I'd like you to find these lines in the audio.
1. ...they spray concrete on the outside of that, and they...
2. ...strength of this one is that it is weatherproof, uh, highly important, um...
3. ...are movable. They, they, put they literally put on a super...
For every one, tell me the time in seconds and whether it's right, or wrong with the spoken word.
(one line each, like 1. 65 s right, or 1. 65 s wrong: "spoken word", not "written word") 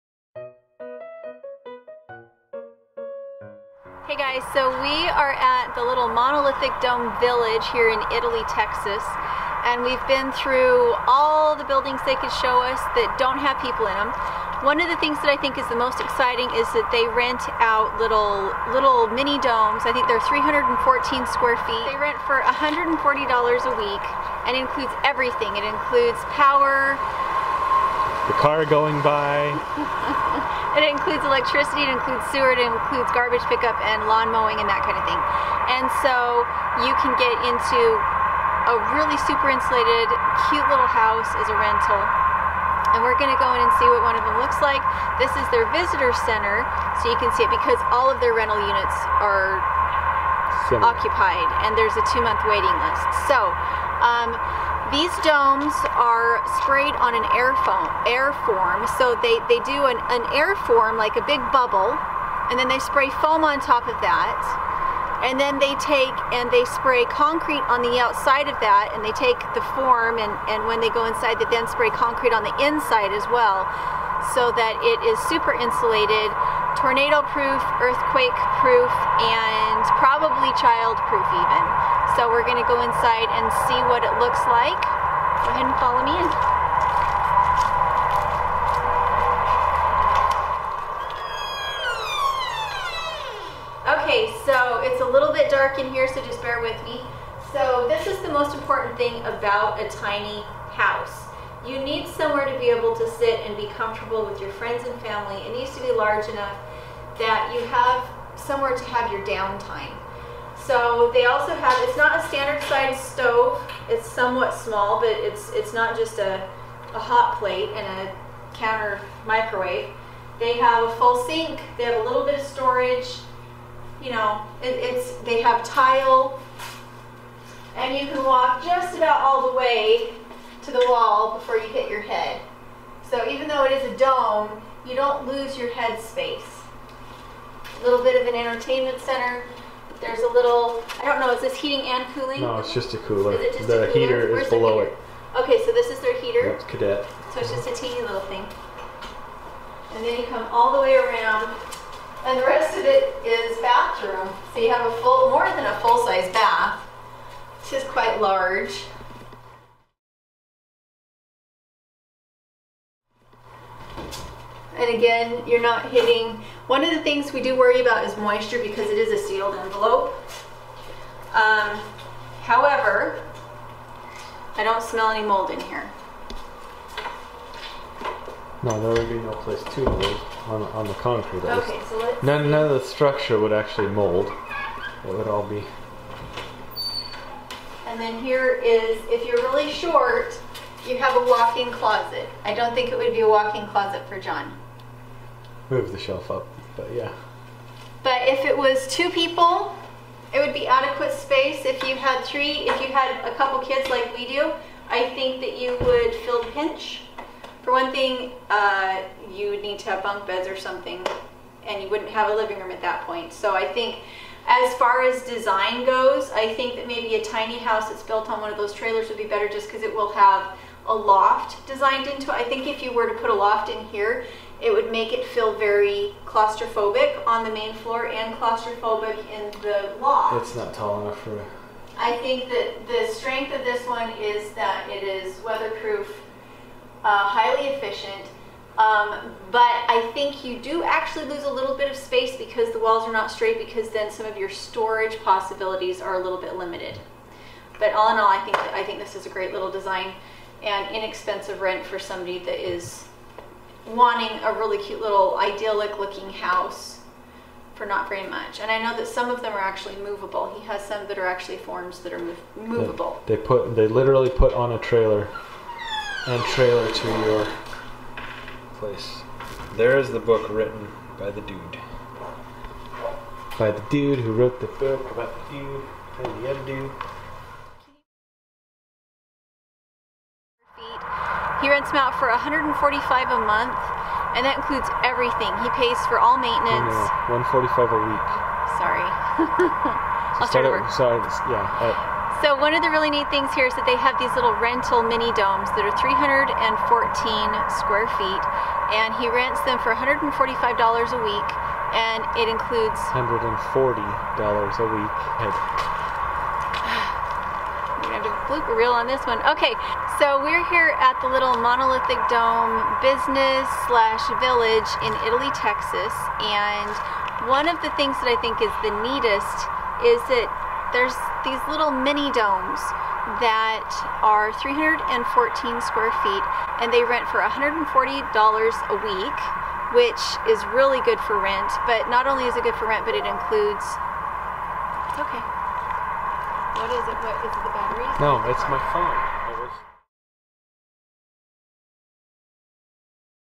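1. 66 s right
2. 233 s wrong: "efficient", not "important"
3. 262 s wrong: "trailer", not "super".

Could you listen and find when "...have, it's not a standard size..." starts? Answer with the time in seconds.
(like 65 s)
111 s.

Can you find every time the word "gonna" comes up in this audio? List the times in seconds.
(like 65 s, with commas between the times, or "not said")
43 s, 82 s, 308 s.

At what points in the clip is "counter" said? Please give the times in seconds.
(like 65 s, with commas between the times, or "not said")
118 s.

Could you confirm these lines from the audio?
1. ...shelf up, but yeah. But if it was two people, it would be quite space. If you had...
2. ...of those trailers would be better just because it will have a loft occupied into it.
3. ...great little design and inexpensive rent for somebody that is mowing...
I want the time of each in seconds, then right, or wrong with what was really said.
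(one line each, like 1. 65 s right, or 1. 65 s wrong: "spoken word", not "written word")
1. 195 s wrong: "adequate", not "quite"
2. 218 s wrong: "designed", not "occupied"
3. 249 s wrong: "wanting", not "mowing".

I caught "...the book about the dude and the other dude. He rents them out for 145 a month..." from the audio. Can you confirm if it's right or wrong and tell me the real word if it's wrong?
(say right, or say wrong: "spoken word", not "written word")
right.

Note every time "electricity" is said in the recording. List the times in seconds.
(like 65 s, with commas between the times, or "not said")
31 s.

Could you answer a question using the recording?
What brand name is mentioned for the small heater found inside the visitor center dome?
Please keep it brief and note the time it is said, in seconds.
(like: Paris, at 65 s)
Cadet, at 146 s.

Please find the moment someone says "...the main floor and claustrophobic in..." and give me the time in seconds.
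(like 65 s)
227 s.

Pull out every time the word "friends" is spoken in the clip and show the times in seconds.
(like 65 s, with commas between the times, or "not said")
104 s.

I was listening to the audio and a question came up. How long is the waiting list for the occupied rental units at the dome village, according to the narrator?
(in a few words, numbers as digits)
2 months.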